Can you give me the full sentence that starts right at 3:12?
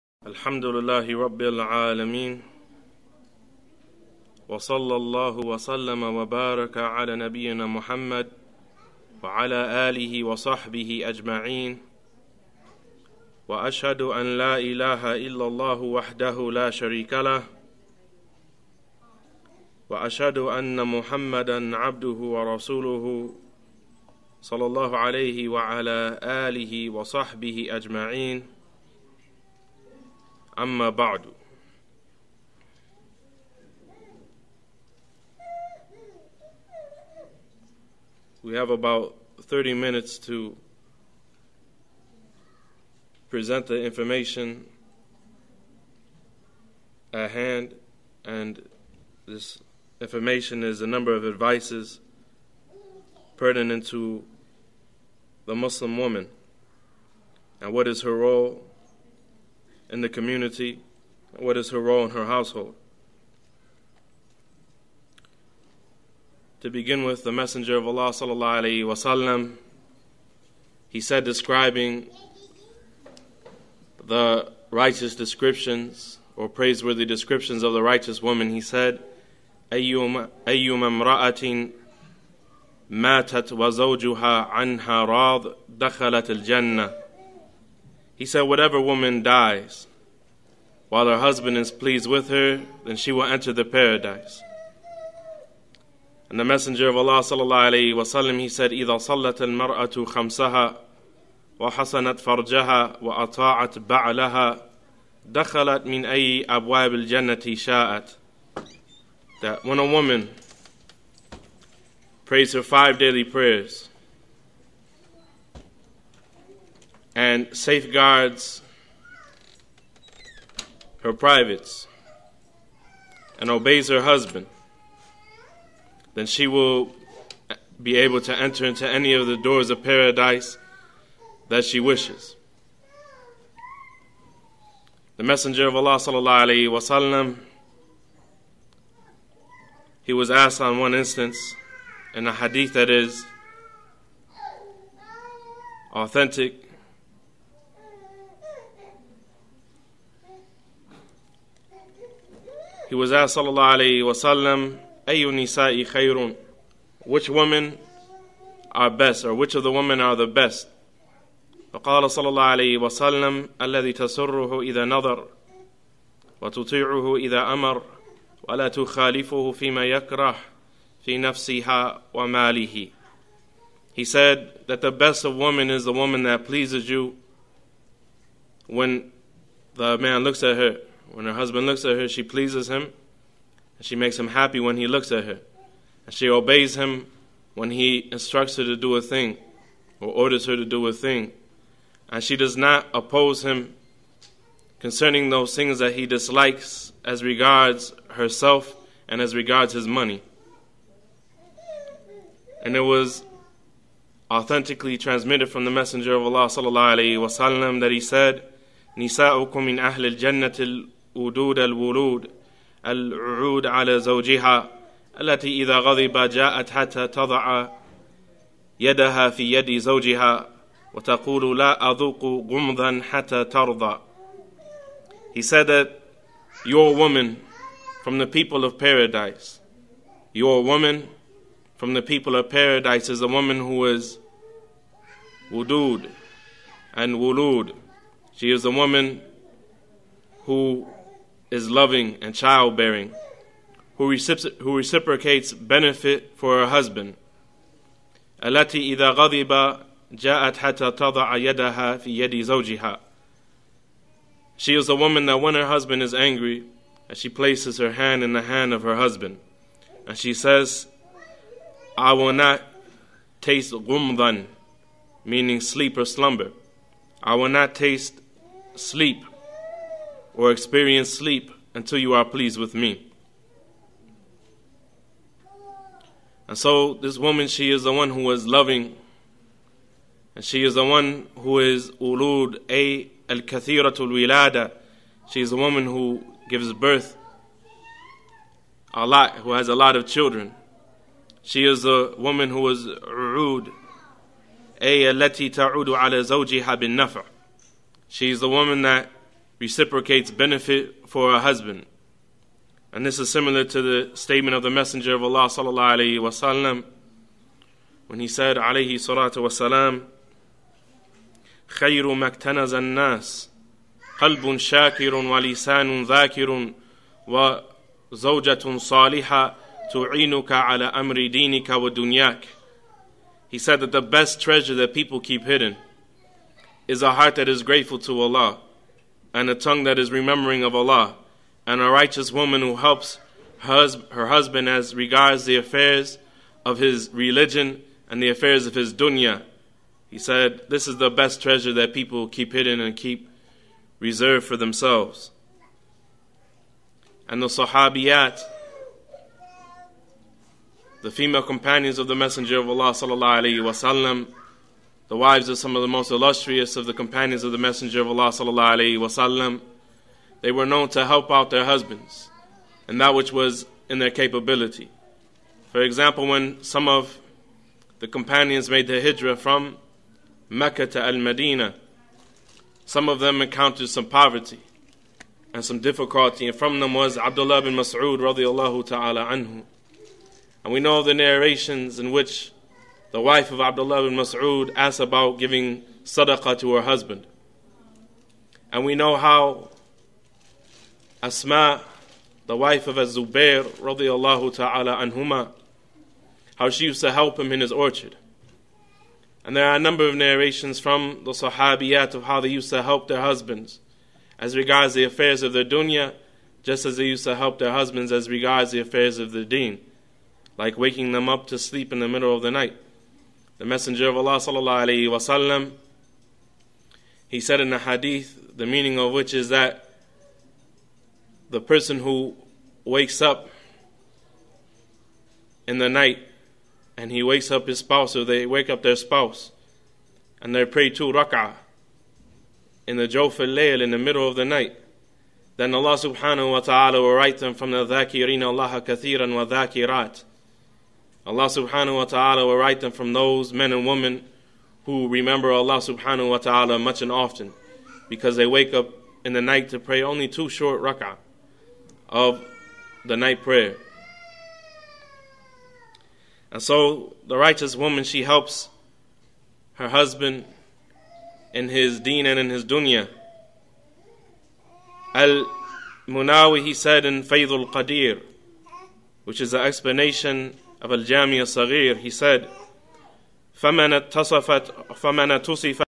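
And she does not oppose him concerning those things that he dislikes as regards herself and as regards his money.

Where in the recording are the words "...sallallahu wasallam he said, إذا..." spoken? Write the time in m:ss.
1:37.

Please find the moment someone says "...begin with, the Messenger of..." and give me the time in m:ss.
1:06.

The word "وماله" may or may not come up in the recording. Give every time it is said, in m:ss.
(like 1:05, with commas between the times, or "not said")
2:52.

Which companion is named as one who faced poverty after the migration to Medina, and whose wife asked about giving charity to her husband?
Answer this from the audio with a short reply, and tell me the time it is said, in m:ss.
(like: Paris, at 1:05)
Abdullah bin Mas'ud, at 6:17.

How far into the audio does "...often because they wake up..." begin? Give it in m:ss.
7:27.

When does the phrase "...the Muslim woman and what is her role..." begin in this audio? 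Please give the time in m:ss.
0:55.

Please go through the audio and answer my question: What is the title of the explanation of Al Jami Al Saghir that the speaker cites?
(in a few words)
Faidul Qadir.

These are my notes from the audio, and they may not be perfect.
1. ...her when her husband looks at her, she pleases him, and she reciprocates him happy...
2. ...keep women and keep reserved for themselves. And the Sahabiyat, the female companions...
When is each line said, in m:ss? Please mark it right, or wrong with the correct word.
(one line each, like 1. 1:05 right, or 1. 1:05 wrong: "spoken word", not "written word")
1. 3:00 wrong: "makes", not "reciprocates"
2. 5:42 wrong: "hidden", not "women".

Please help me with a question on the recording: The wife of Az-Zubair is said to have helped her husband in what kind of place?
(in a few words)
His orchard.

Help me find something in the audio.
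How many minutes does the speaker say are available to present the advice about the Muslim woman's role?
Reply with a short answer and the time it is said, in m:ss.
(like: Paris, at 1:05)
30, at 0:39.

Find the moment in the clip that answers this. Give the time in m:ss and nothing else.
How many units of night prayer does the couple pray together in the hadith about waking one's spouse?
7:10.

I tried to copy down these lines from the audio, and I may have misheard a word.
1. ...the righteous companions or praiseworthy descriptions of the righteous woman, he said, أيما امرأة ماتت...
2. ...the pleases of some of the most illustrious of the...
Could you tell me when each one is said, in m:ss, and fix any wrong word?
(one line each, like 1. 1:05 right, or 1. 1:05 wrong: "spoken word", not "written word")
1. 1:14 wrong: "descriptions", not "companions"
2. 5:55 wrong: "wives", not "pleases".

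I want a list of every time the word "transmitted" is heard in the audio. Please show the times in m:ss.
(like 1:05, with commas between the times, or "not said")
3:24.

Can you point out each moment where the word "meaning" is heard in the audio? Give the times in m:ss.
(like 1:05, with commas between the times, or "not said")
4:25, 6:58.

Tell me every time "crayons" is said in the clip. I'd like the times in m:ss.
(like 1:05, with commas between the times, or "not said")
not said.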